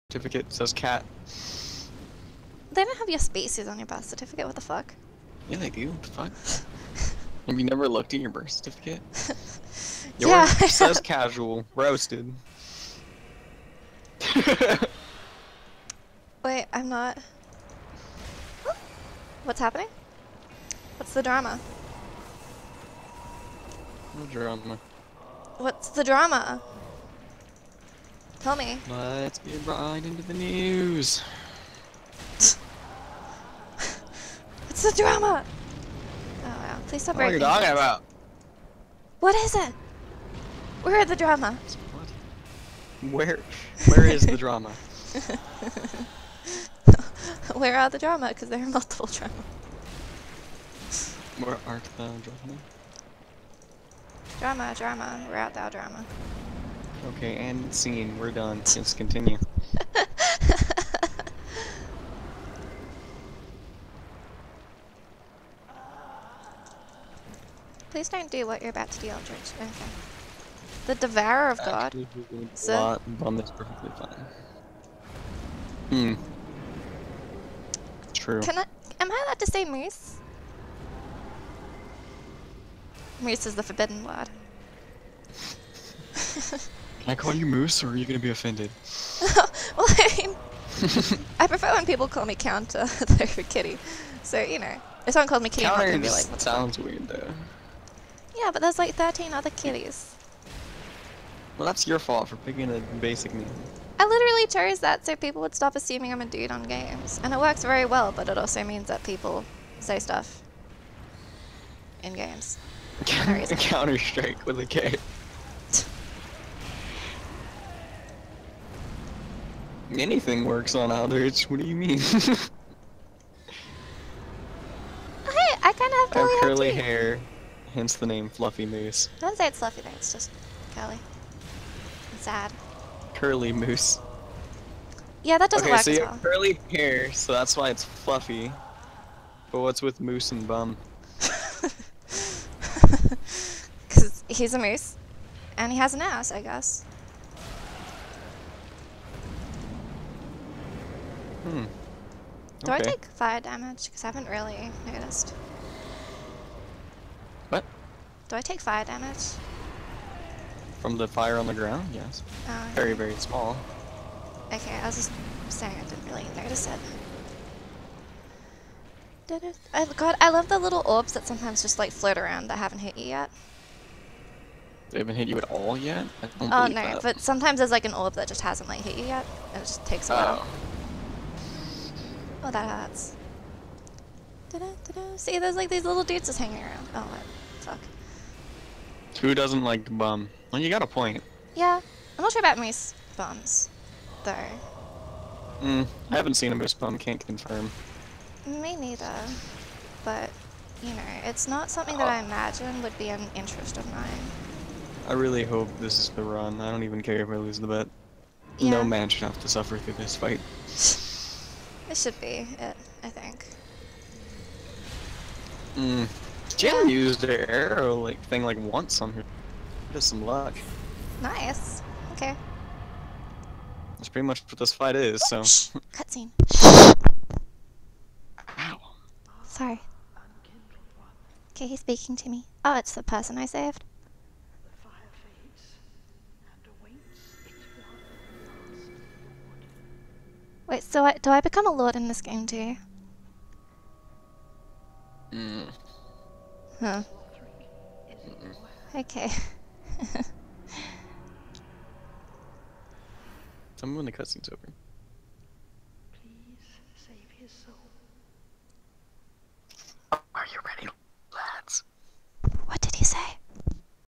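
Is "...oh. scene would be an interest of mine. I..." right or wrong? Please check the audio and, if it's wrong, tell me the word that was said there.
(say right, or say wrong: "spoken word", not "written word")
wrong: "imagine", not "scene".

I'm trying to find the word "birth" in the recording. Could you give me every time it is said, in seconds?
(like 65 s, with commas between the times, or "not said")
3 s, 8 s.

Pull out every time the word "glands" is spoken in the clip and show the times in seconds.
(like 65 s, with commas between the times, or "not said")
not said.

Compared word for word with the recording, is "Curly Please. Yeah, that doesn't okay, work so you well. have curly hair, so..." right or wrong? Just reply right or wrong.
wrong.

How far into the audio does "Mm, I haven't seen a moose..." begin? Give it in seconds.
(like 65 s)
195 s.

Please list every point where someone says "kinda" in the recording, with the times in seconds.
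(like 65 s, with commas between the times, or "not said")
125 s.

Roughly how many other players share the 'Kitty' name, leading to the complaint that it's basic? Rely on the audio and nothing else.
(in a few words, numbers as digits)
13.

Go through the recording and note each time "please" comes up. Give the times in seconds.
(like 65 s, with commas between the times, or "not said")
36 s, 67 s, 256 s.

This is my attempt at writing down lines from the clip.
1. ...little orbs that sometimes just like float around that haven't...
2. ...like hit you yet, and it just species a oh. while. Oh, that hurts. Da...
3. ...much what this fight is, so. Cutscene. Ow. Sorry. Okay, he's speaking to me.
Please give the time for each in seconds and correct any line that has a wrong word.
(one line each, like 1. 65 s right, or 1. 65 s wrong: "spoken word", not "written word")
1. 170 s right
2. 178 s wrong: "takes", not "species"
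3. 224 s right.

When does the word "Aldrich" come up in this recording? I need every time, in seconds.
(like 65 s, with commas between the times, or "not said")
69 s, 120 s.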